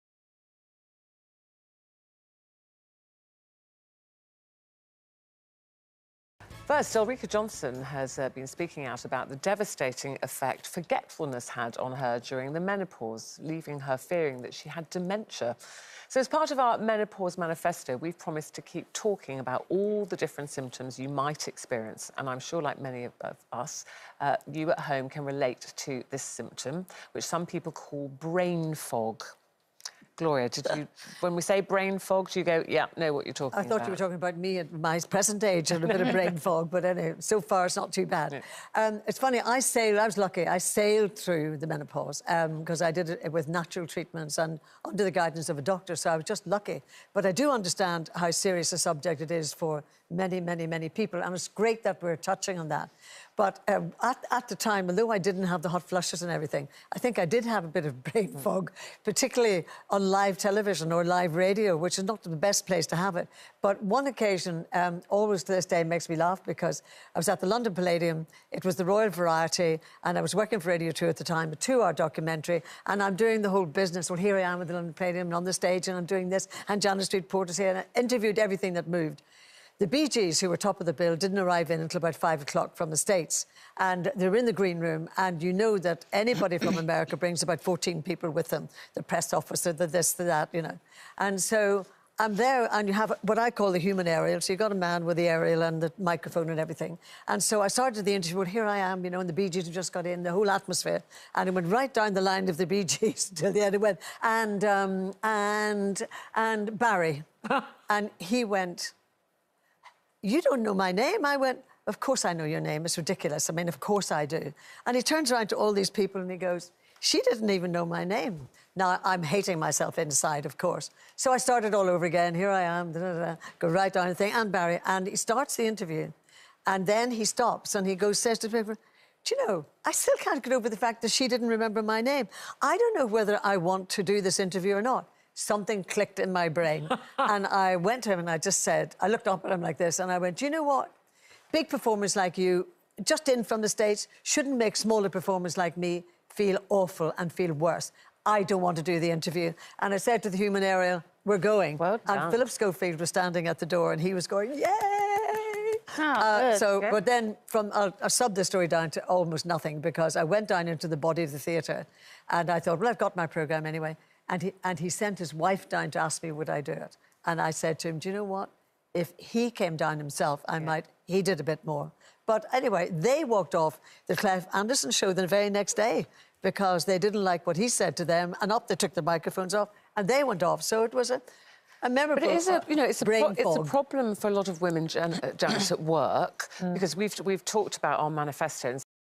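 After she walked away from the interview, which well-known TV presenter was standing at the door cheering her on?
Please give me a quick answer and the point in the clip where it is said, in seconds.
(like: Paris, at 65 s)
Philip Schofield, at 152 s.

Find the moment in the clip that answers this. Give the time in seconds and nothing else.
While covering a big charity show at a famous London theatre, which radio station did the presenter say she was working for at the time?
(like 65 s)
70 s.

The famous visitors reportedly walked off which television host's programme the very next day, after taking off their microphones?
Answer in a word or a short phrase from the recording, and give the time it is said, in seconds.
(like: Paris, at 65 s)
Clive Anderson show, at 174 s.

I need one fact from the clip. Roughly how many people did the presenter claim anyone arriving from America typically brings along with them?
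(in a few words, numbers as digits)
14.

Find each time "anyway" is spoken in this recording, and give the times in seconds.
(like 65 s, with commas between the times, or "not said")
36 s, 163 s, 172 s.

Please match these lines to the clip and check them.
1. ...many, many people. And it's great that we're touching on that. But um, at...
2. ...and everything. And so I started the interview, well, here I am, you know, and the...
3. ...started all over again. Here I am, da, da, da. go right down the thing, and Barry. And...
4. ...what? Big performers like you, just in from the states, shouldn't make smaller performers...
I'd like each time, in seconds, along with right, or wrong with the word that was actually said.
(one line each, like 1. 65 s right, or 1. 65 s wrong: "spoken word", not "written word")
1. 50 s right
2. 96 s right
3. 121 s right
4. 140 s right.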